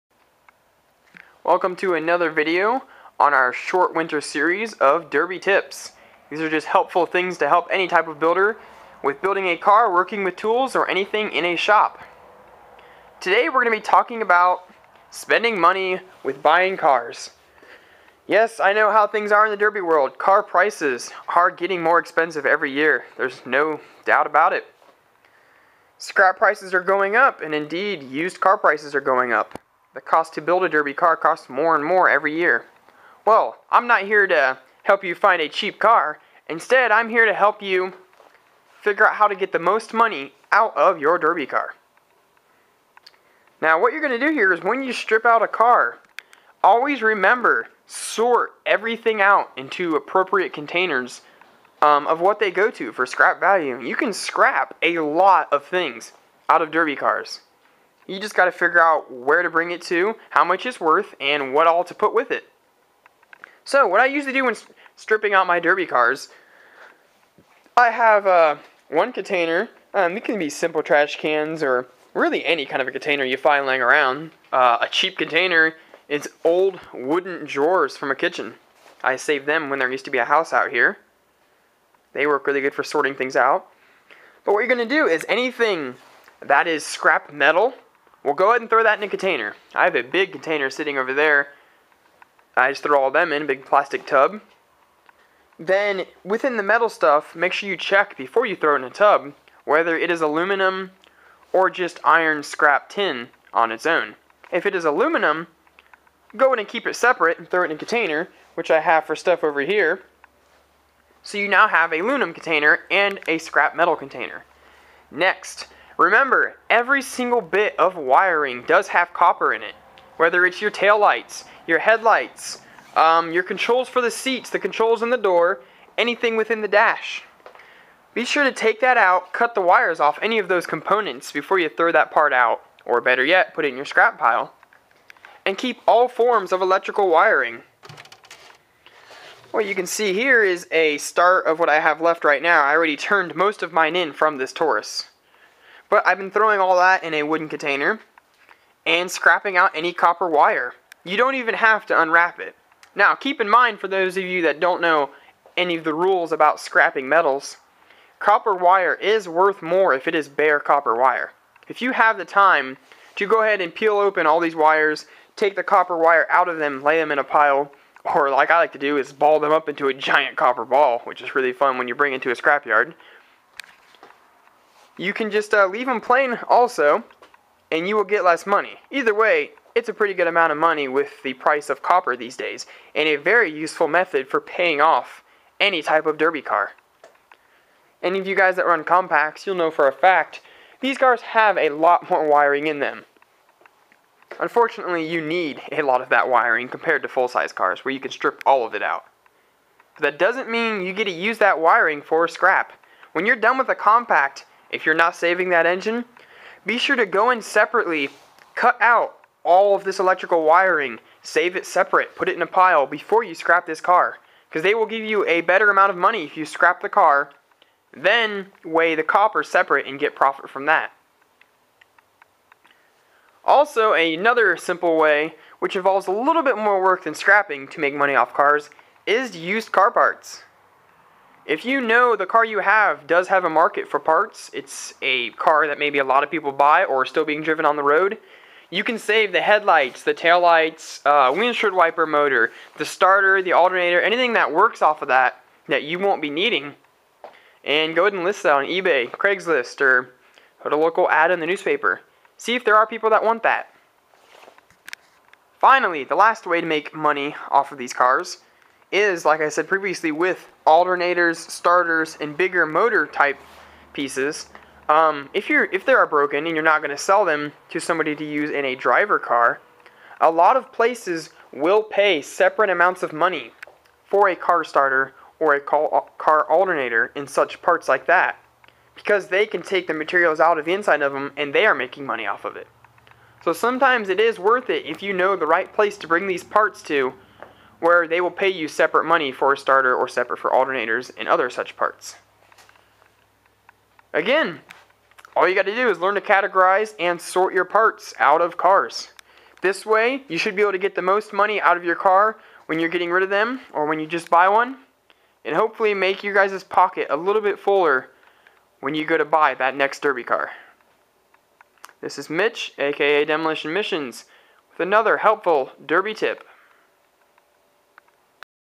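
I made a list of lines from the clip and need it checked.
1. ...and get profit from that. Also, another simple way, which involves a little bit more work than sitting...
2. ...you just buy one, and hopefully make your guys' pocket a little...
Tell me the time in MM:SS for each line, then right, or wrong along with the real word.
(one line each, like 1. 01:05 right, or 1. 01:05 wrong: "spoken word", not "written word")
1. 03:39 wrong: "scrapping", not "sitting"
2. 05:03 right.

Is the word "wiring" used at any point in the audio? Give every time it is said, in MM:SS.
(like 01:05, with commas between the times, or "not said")
01:57, 02:17, 03:12, 03:16, 03:21, 03:30.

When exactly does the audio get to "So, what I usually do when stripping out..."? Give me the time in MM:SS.
01:03.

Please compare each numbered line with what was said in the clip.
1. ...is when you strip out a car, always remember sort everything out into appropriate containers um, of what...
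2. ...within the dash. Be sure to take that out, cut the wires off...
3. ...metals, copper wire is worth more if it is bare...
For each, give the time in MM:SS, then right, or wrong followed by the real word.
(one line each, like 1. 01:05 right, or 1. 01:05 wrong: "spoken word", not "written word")
1. 00:44 right
2. 02:06 right
3. 02:37 right.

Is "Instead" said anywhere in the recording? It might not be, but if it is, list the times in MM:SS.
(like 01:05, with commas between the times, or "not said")
00:36.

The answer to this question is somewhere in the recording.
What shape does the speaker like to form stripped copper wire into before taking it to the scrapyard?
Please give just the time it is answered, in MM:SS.
02:49.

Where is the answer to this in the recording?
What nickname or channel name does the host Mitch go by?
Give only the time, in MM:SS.
05:13.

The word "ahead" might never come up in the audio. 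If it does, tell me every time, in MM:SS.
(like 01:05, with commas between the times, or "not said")
01:28, 02:43, 04:08.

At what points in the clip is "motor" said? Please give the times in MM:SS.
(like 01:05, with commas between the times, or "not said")
04:02, 04:22.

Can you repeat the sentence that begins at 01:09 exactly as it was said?
Um, it can be simple trash cans or really any kind of a container you find laying around.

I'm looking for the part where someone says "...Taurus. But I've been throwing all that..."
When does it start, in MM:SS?
02:24.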